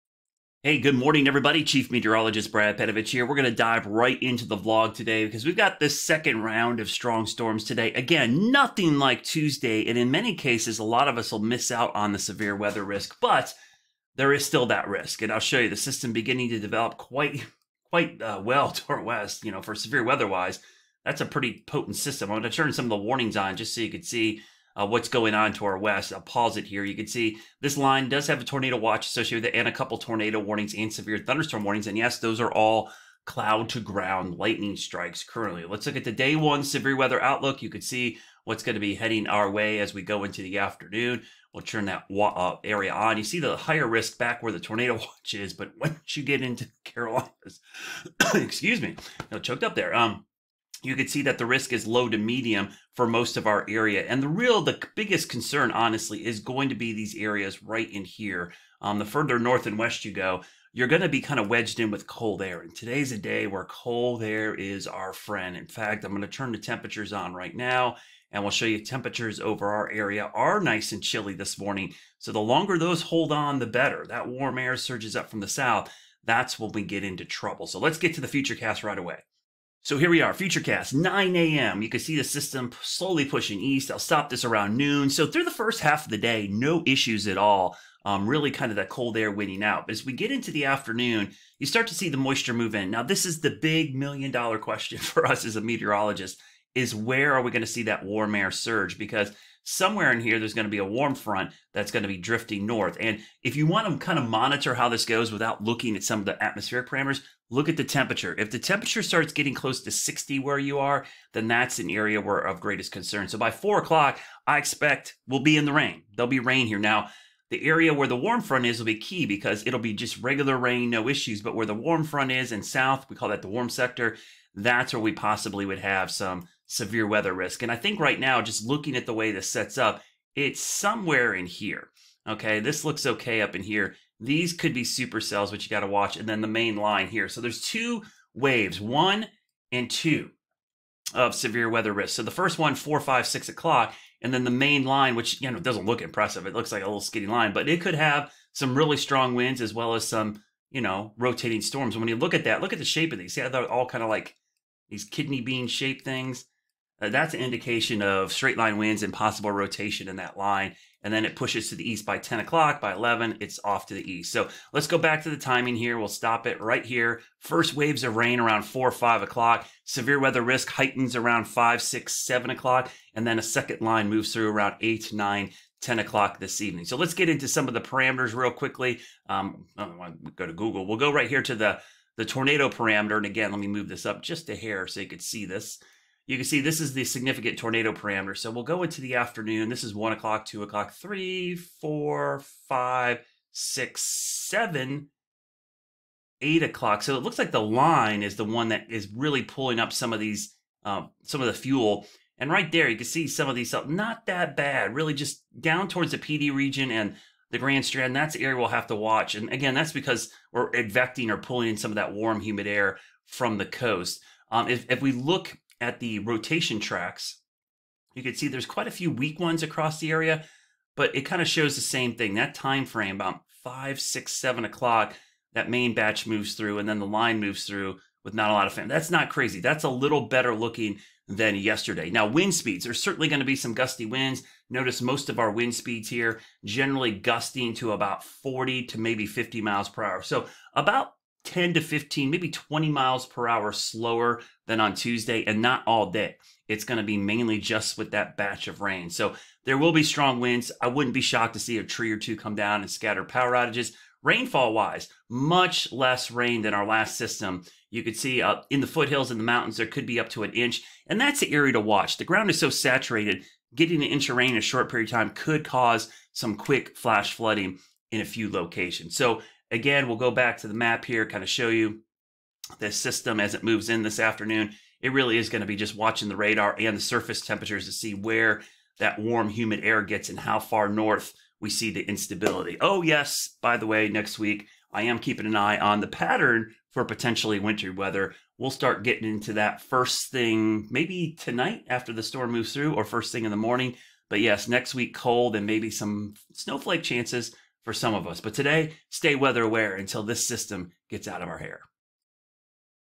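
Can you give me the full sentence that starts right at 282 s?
Oh, yes, by the way, next week, I am keeping an eye on the pattern for potentially wintry weather.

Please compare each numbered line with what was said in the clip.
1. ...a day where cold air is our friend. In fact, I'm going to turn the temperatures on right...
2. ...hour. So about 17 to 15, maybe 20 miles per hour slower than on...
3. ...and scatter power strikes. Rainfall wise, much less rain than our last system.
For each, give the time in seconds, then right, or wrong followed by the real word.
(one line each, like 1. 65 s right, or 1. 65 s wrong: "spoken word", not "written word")
1. 63 s right
2. 240 s wrong: "10", not "17"
3. 252 s wrong: "outages", not "strikes".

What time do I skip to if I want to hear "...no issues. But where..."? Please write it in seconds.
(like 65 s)
120 s.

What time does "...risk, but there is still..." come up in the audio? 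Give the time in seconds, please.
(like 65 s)
12 s.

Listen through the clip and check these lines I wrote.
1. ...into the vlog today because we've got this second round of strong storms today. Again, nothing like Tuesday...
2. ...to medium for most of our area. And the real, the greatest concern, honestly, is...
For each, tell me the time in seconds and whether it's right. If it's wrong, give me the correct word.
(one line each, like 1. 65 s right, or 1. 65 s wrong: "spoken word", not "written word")
1. 4 s right
2. 52 s wrong: "biggest", not "greatest".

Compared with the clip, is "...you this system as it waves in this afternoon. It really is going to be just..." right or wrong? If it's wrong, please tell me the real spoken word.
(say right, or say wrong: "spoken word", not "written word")
wrong: "moves", not "waves".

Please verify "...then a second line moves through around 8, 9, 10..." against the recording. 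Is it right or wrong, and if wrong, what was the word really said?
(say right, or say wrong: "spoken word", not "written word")
right.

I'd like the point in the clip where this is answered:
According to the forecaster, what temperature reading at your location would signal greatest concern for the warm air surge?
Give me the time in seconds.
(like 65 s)
109 s.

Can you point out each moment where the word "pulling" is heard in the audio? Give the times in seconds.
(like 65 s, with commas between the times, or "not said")
199 s, 211 s.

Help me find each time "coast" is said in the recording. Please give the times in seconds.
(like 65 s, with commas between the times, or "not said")
213 s.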